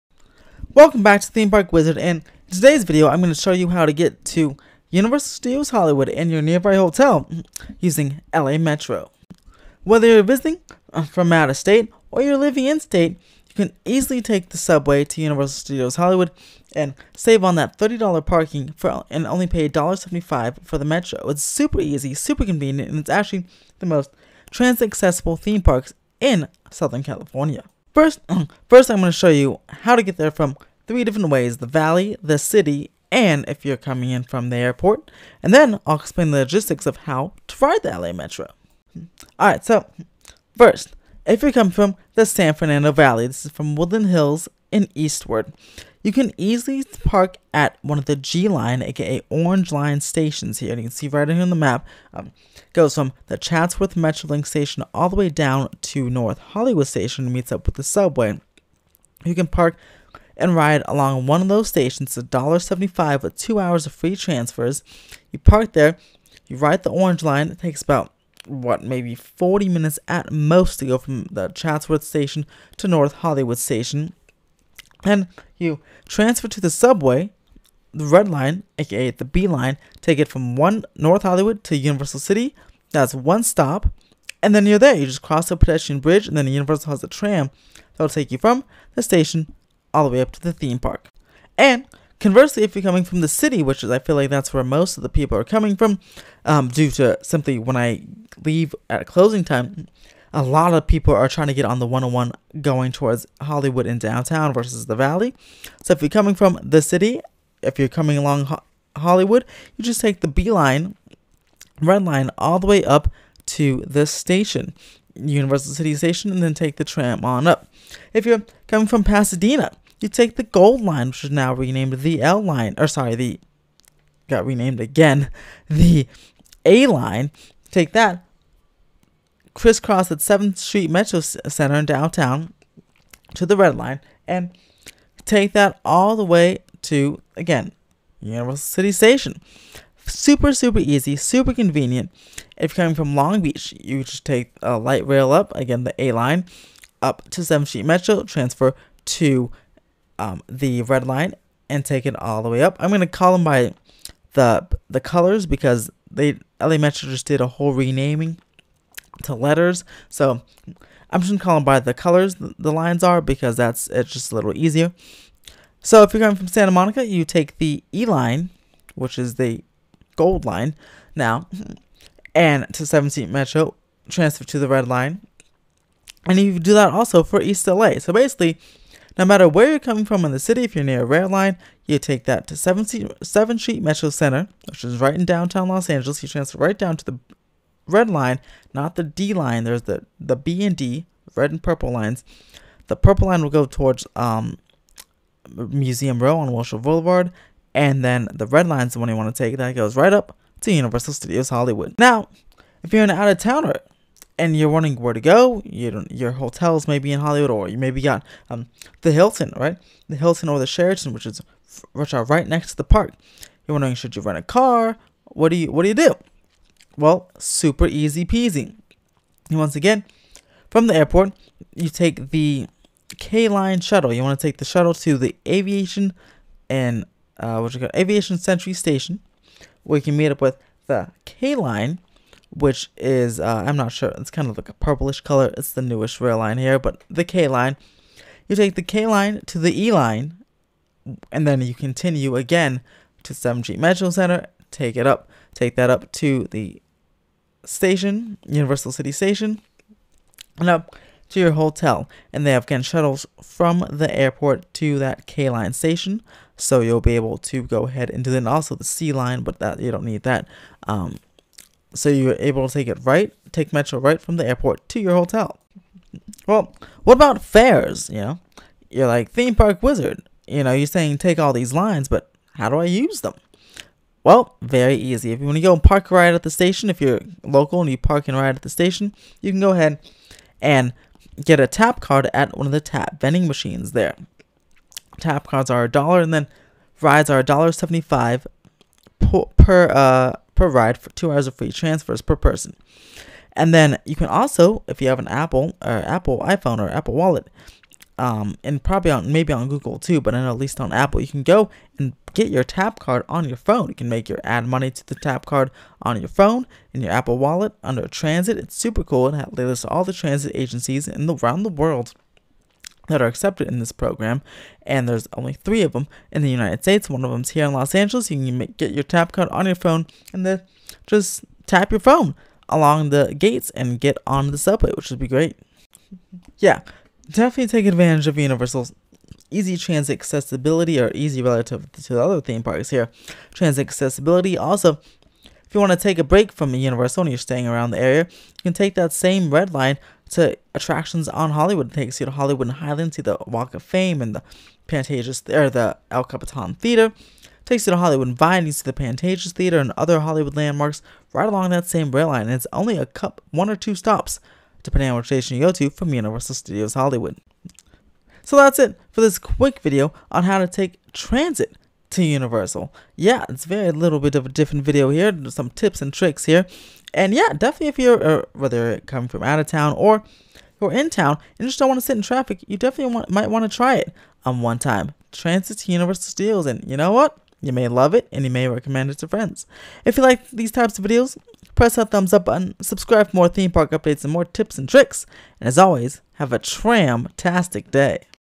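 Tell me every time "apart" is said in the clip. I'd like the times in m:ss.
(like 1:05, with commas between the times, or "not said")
not said.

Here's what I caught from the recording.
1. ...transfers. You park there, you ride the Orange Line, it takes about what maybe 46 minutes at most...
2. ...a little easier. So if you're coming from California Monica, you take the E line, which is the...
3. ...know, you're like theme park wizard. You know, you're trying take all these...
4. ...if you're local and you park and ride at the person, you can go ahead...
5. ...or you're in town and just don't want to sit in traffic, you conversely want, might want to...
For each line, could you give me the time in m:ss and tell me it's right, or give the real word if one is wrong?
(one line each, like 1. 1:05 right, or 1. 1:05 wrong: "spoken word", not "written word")
1. 1:04 wrong: "40", not "46"
2. 2:44 wrong: "Santa", not "California"
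3. 4:28 wrong: "saying", not "trying"
4. 4:36 wrong: "station", not "person"
5. 6:09 wrong: "definitely", not "conversely".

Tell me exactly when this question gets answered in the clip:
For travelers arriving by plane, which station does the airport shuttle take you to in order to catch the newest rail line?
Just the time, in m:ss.
3:47.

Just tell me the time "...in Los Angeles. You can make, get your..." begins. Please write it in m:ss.
5:17.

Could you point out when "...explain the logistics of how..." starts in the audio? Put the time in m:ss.
0:35.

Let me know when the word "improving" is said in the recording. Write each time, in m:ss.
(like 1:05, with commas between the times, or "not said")
not said.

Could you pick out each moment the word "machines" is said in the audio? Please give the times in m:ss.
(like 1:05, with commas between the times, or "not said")
4:43.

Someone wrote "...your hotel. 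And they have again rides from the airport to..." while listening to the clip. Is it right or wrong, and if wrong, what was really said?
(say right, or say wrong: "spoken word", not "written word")
wrong: "shuttles", not "rides".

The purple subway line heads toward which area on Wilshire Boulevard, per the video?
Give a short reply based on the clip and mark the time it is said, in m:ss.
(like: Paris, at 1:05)
Museum Row, at 3:15.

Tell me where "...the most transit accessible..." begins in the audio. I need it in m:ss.
0:23.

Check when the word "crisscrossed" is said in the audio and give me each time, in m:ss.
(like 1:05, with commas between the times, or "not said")
2:09.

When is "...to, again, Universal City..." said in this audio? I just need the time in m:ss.
2:16.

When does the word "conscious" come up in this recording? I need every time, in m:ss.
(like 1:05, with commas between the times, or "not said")
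not said.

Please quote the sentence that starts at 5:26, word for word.
Yeah, definitely take advantage of Universal's easy transit accessibility or easy relative to the other theme parks here.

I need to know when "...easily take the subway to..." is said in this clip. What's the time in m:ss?
0:13.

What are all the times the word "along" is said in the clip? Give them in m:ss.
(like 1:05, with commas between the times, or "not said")
1:00, 1:48, 5:22, 5:51.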